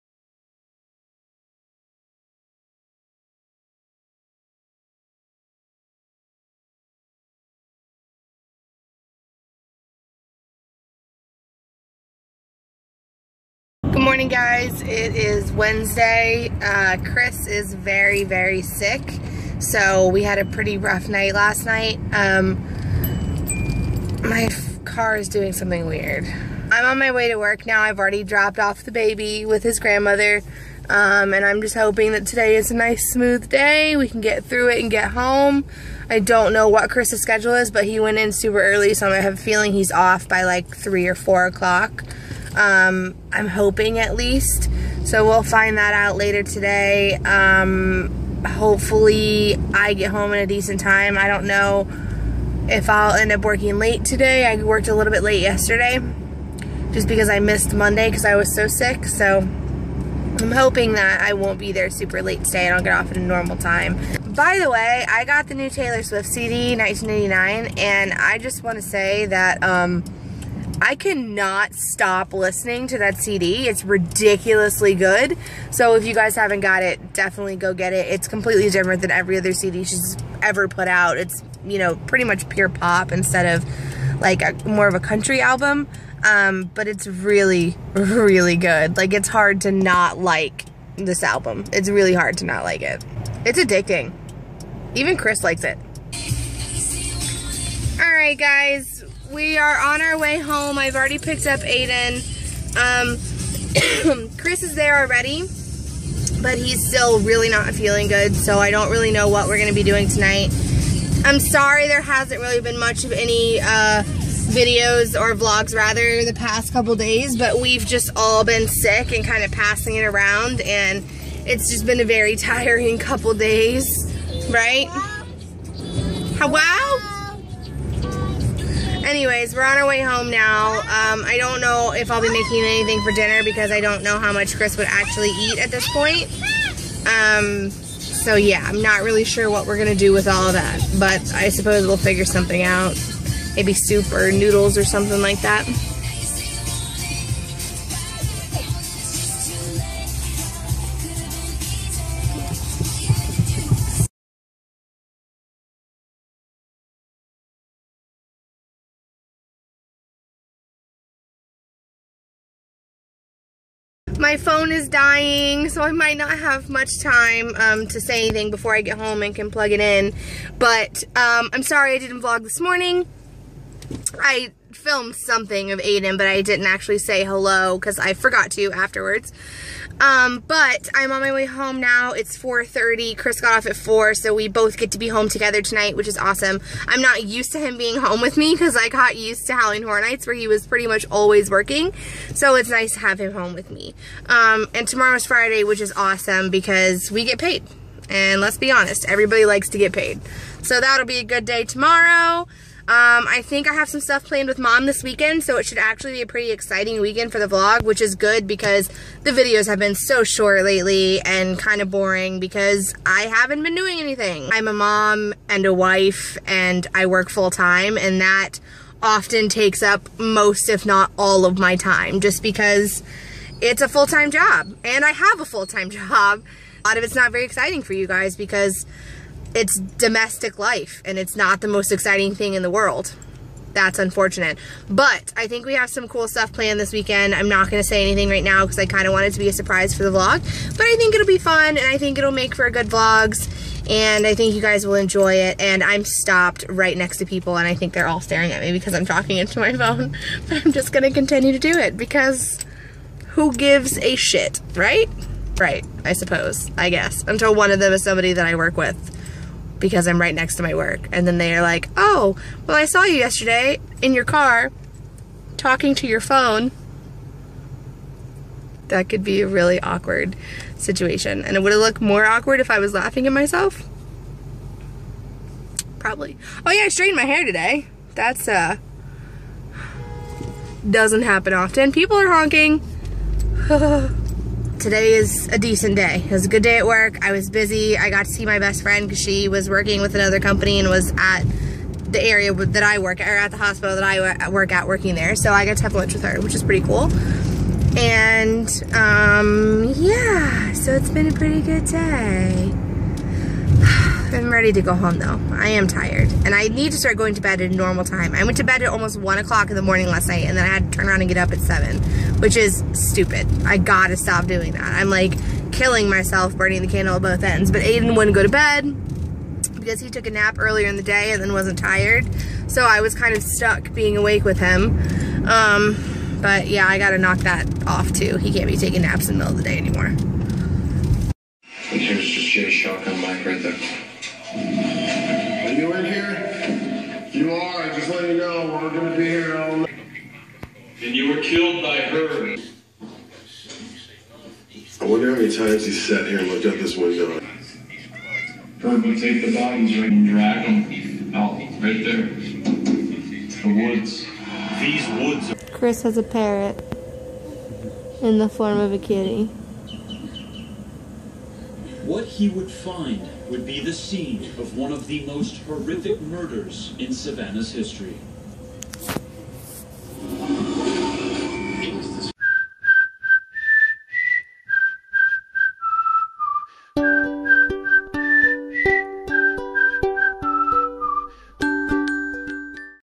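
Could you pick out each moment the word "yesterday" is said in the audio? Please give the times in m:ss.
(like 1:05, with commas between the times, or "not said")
0:55, 4:23.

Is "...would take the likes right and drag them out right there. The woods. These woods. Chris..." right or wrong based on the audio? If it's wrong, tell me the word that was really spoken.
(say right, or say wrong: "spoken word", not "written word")
wrong: "bodies", not "likes".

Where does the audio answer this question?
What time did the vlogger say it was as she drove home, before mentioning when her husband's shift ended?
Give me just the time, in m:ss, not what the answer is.
3:02.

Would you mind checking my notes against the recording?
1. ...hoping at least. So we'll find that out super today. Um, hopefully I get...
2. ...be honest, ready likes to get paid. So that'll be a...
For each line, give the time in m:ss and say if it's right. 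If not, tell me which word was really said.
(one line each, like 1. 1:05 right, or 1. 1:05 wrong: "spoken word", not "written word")
1. 0:43 wrong: "later", not "super"
2. 3:18 wrong: "everybody", not "ready".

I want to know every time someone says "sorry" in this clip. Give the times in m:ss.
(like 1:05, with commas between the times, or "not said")
1:51, 2:51.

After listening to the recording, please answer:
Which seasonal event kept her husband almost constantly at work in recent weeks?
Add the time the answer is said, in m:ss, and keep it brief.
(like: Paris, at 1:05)
Halloween Horror Nights, at 3:09.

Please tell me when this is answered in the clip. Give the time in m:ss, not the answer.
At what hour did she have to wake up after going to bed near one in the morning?
5:11.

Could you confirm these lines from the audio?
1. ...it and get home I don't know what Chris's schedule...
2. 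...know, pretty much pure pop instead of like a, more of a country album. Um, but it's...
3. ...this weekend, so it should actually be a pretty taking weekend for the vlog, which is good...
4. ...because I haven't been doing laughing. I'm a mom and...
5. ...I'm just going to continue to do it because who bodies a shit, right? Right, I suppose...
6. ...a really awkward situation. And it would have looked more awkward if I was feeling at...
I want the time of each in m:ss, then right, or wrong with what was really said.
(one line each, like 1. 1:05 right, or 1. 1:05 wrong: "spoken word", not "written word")
1. 0:34 right
2. 1:21 right
3. 3:24 wrong: "exciting", not "taking"
4. 3:32 wrong: "anything", not "laughing"
5. 4:10 wrong: "gives", not "bodies"
6. 4:29 wrong: "laughing", not "feeling".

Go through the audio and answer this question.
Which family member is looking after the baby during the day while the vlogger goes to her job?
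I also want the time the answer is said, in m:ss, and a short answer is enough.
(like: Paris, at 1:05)
His grandmother, at 0:29.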